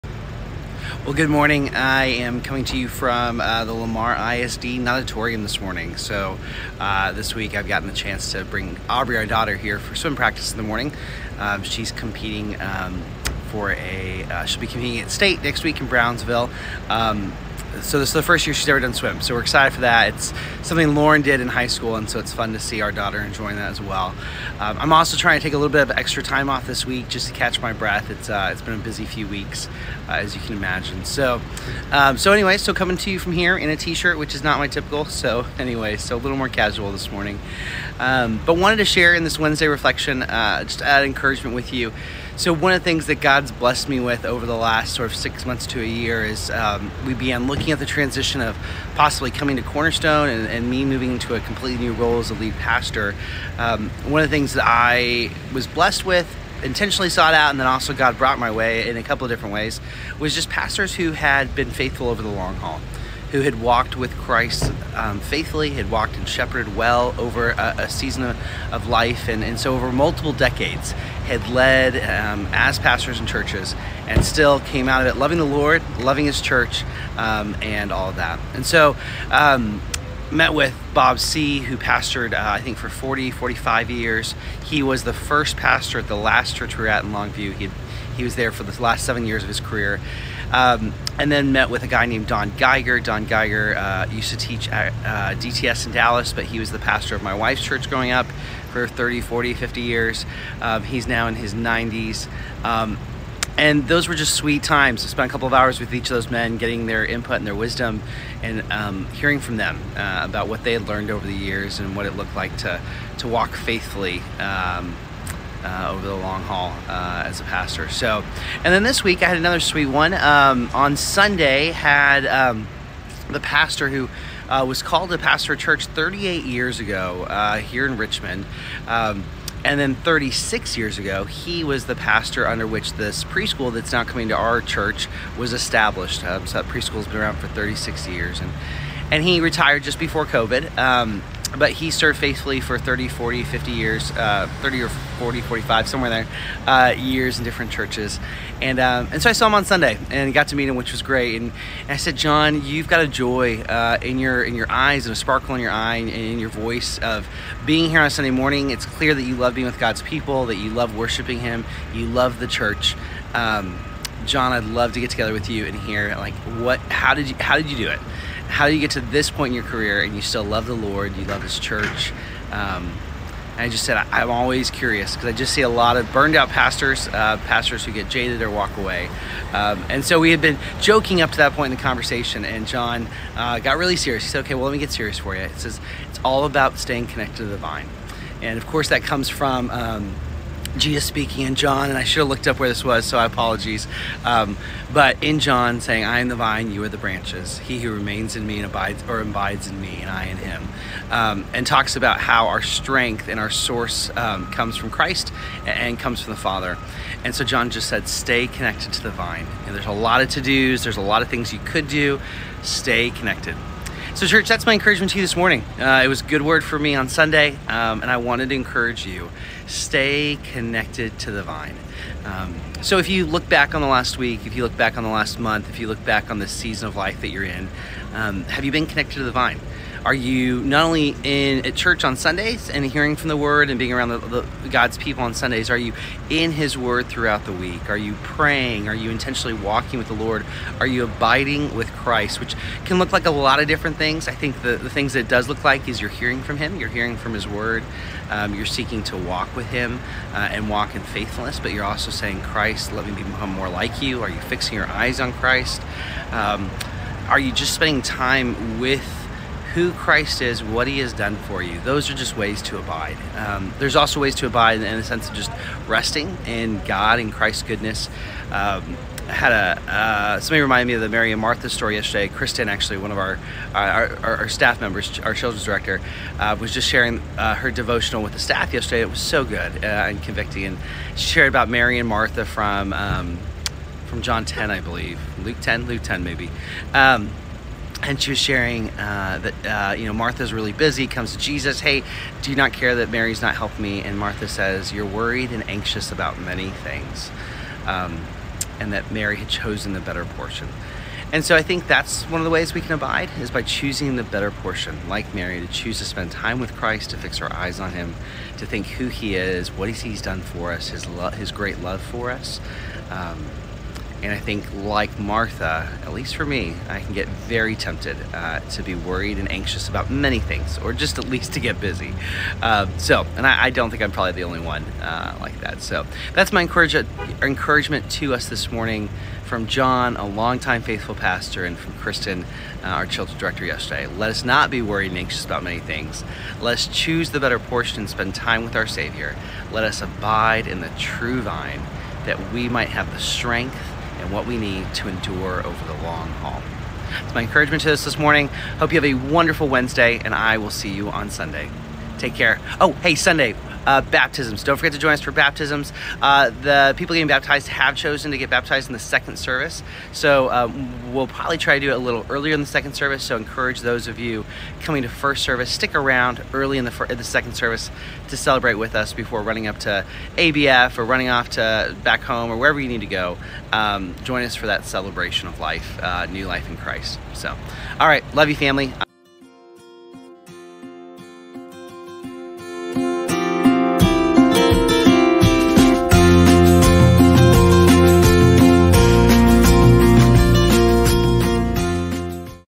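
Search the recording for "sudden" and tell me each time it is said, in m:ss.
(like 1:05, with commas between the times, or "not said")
not said.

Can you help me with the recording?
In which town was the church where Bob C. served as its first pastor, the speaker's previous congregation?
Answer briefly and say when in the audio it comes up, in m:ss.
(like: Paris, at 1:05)
Longview, at 1:27.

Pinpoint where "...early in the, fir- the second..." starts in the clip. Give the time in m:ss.
6:06.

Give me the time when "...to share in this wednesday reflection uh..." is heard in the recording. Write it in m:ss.
0:38.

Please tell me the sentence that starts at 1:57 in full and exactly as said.
So, and then this week I had another sweet one.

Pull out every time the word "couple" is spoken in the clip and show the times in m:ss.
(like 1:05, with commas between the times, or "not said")
0:59, 1:45.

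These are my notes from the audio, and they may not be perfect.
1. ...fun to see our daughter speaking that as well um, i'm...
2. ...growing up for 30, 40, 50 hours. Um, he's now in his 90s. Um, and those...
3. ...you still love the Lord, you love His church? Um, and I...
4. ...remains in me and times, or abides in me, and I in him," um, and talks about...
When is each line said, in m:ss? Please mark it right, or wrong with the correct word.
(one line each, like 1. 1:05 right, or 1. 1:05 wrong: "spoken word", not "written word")
1. 0:22 wrong: "enjoying", not "speaking"
2. 1:37 wrong: "years", not "hours"
3. 2:50 right
4. 3:17 wrong: "abides", not "times".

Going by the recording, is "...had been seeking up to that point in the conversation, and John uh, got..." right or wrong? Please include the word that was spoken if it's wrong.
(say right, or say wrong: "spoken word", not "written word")
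wrong: "joking", not "seeking".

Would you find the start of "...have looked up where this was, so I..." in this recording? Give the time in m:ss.
3:12.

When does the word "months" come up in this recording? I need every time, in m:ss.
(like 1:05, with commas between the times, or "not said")
0:45, 3:45.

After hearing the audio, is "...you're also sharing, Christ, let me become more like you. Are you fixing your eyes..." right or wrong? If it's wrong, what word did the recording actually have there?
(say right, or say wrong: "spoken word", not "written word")
wrong: "saying", not "sharing".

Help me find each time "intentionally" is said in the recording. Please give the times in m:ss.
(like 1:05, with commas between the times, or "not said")
0:56, 3:59.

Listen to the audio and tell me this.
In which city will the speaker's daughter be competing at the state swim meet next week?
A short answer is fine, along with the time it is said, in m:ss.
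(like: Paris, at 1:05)
Brownsville, at 0:15.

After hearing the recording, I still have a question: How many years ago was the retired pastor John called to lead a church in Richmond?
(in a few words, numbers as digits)
38.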